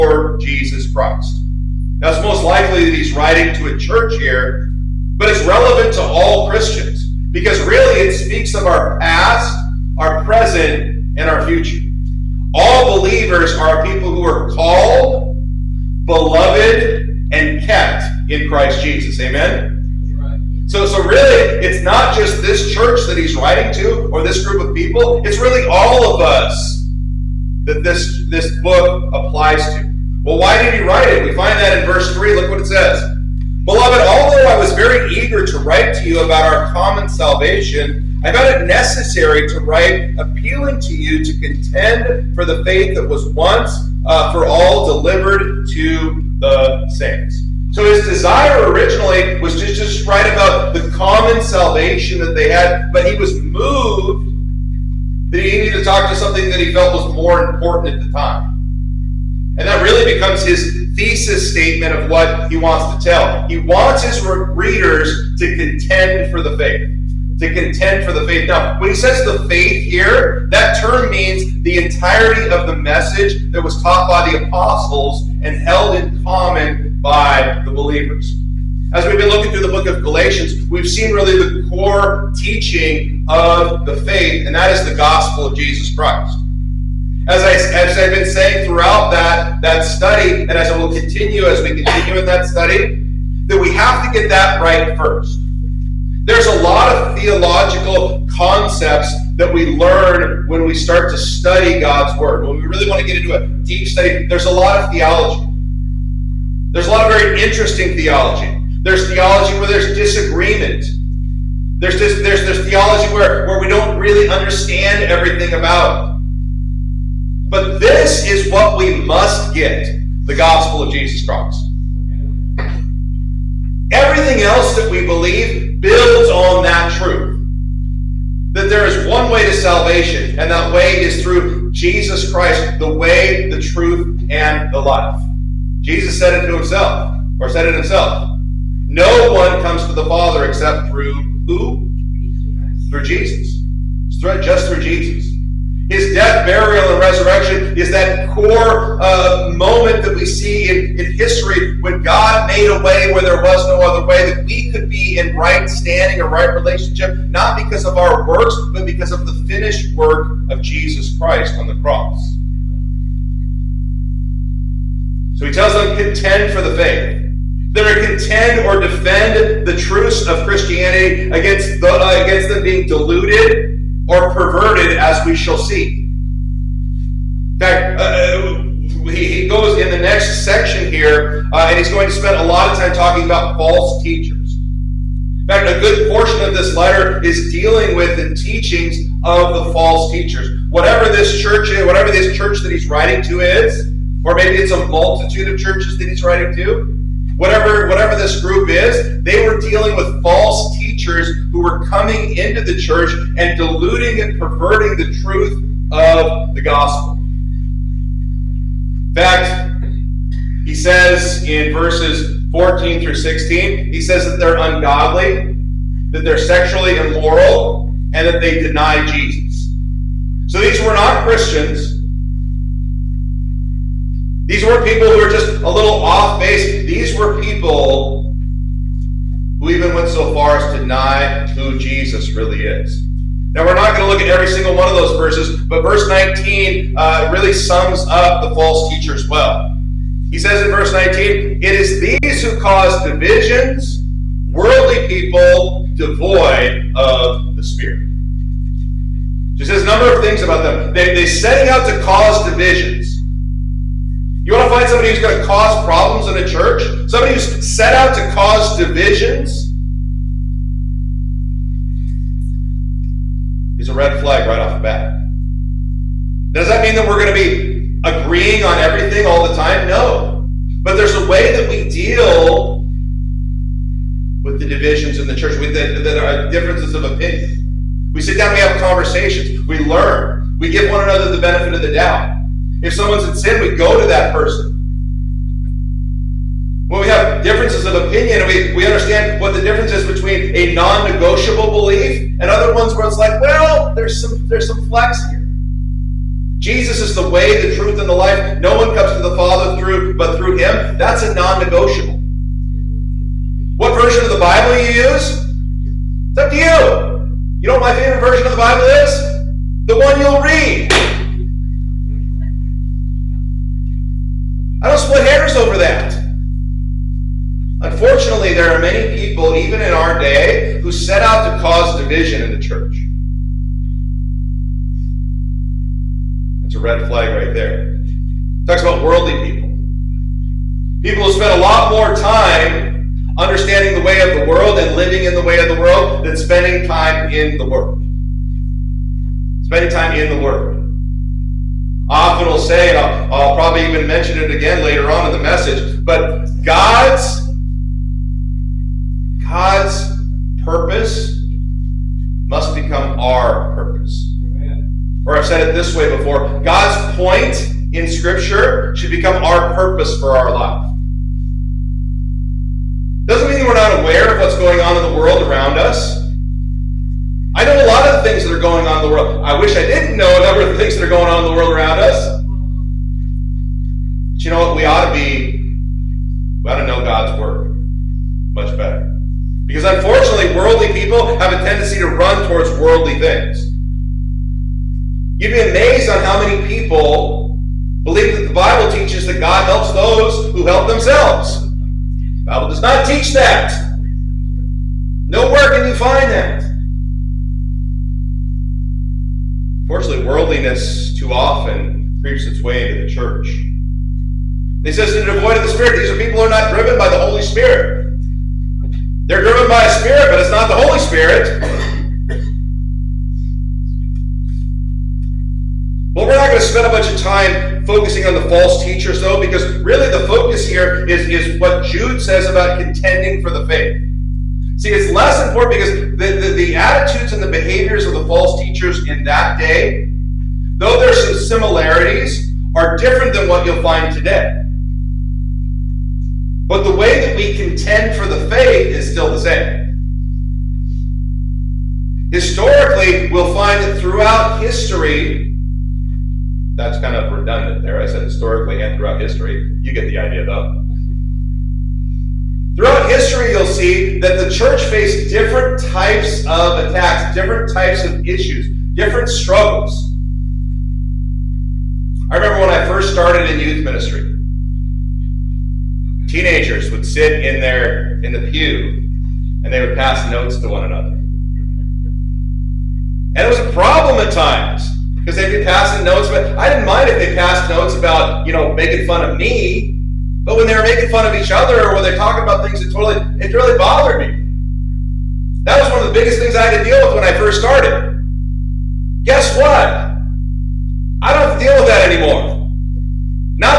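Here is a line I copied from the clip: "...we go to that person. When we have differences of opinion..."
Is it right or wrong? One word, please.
right.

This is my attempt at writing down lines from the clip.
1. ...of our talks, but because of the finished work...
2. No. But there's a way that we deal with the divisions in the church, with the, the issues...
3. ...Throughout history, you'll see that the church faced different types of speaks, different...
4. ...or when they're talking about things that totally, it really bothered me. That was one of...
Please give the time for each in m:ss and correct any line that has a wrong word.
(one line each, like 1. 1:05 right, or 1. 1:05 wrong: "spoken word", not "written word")
1. 2:37 wrong: "works", not "talks"
2. 4:29 wrong: "differences", not "issues"
3. 7:32 wrong: "attacks", not "speaks"
4. 8:01 right.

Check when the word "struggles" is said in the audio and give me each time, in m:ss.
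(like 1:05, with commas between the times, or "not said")
7:39.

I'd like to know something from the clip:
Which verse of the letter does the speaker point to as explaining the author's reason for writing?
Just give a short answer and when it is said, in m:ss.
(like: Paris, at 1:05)
verse 3, at 0:31.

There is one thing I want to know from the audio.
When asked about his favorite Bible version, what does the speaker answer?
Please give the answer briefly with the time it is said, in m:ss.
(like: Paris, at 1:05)
The one you'll read, at 5:09.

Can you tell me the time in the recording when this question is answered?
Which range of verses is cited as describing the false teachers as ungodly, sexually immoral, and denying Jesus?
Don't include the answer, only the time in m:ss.
3:32.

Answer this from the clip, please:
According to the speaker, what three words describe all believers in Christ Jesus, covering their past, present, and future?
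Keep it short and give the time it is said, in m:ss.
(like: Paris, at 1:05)
called, beloved, and kept, at 0:14.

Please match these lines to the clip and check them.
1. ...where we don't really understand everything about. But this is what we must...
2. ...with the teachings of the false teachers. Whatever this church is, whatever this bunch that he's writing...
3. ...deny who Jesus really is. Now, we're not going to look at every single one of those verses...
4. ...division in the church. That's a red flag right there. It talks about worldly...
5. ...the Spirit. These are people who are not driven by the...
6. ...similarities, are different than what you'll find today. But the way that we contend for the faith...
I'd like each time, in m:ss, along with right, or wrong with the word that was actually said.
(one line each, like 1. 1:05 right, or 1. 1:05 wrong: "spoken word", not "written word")
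1. 1:53 right
2. 3:07 wrong: "church", not "bunch"
3. 3:50 right
4. 5:22 right
5. 6:45 right
6. 7:11 right.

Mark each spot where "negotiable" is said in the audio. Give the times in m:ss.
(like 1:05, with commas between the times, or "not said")
4:50, 5:01.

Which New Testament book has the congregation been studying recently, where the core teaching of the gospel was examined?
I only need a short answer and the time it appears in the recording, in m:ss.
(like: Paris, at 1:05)
Galatians, at 1:20.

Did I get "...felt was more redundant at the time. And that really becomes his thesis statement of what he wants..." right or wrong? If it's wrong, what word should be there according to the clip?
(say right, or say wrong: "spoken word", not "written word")
wrong: "important", not "redundant".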